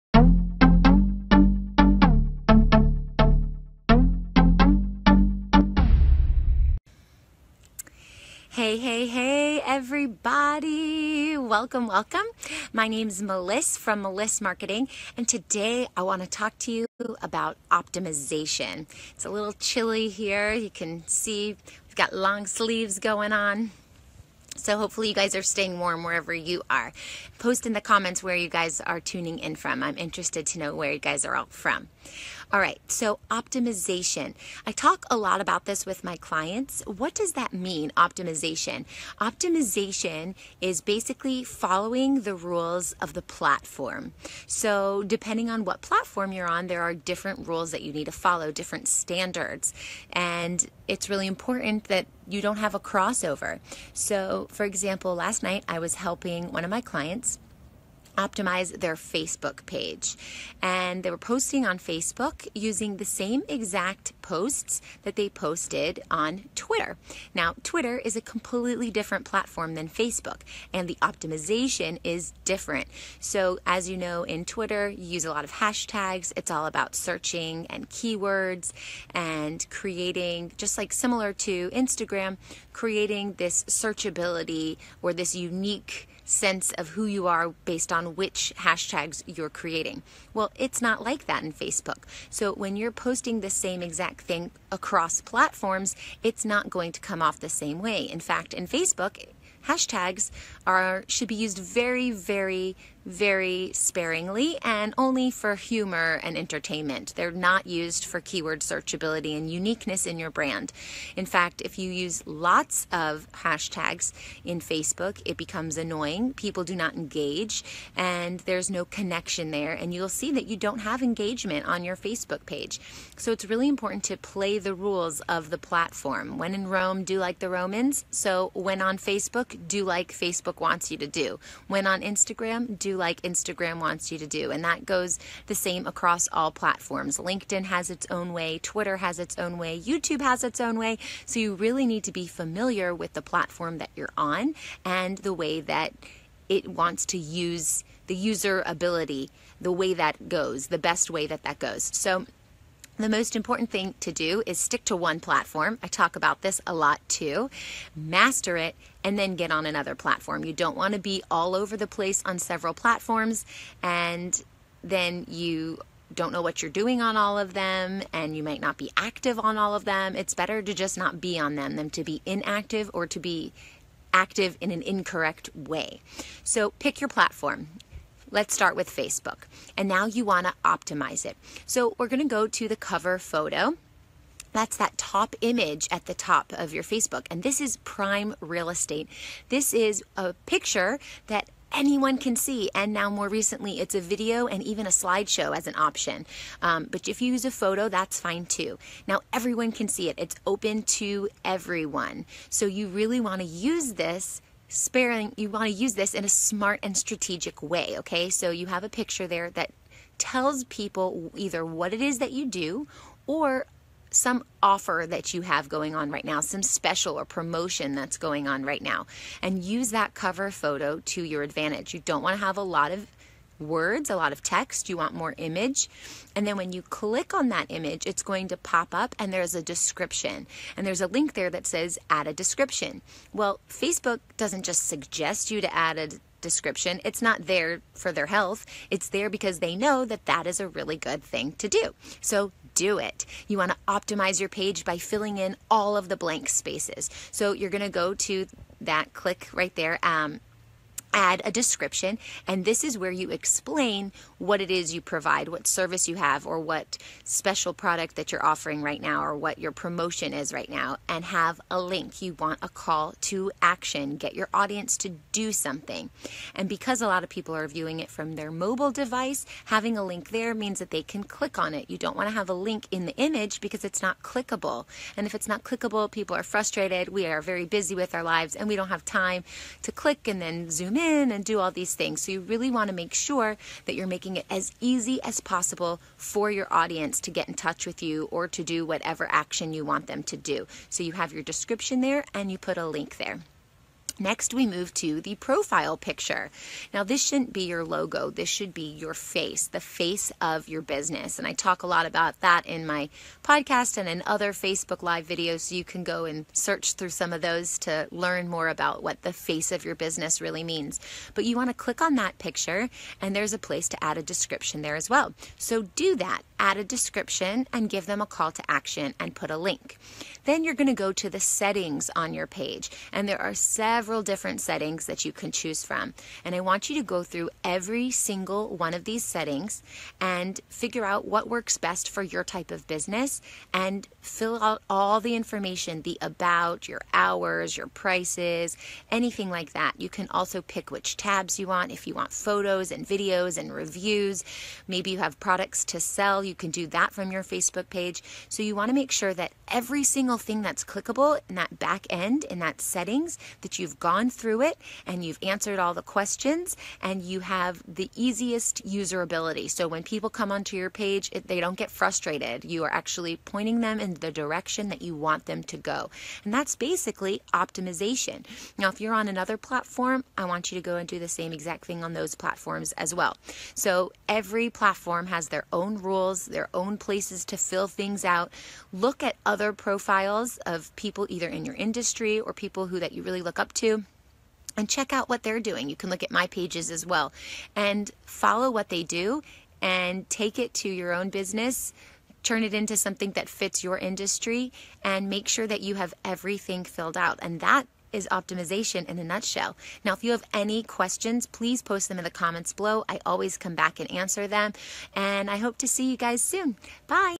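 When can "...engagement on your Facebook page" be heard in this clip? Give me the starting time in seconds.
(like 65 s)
121 s.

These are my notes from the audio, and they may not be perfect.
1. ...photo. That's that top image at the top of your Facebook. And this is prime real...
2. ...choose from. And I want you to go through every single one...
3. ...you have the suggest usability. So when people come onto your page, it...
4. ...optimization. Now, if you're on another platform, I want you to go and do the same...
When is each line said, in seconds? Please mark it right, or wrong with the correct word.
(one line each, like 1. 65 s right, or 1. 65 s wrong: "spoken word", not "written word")
1. 183 s right
2. 325 s right
3. 357 s wrong: "easiest", not "suggest"
4. 367 s right.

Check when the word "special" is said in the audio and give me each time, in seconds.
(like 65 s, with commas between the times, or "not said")
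216 s, 257 s.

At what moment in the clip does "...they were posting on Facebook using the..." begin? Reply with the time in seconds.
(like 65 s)
61 s.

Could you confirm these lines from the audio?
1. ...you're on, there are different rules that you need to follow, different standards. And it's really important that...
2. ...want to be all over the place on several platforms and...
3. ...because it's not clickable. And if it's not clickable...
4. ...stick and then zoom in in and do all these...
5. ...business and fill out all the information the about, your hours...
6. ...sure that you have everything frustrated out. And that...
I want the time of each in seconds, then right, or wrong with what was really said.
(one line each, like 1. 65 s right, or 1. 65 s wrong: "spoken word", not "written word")
1. 46 s right
2. 160 s right
3. 273 s right
4. 279 s wrong: "click", not "stick"
5. 332 s right
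6. 395 s wrong: "filled", not "frustrated".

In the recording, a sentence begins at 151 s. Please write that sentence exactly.
So the most important thing to do is stick to one platform.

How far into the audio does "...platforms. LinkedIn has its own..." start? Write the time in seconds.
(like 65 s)
136 s.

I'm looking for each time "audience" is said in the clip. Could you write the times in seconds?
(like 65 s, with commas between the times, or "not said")
264 s, 286 s.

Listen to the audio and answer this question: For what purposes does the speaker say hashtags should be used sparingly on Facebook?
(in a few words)
Humor and entertainment.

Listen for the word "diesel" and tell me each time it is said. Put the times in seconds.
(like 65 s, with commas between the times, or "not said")
not said.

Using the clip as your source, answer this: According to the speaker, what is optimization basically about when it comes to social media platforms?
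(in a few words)
Following the rules of the platform.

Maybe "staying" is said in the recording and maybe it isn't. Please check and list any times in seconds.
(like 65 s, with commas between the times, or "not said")
25 s.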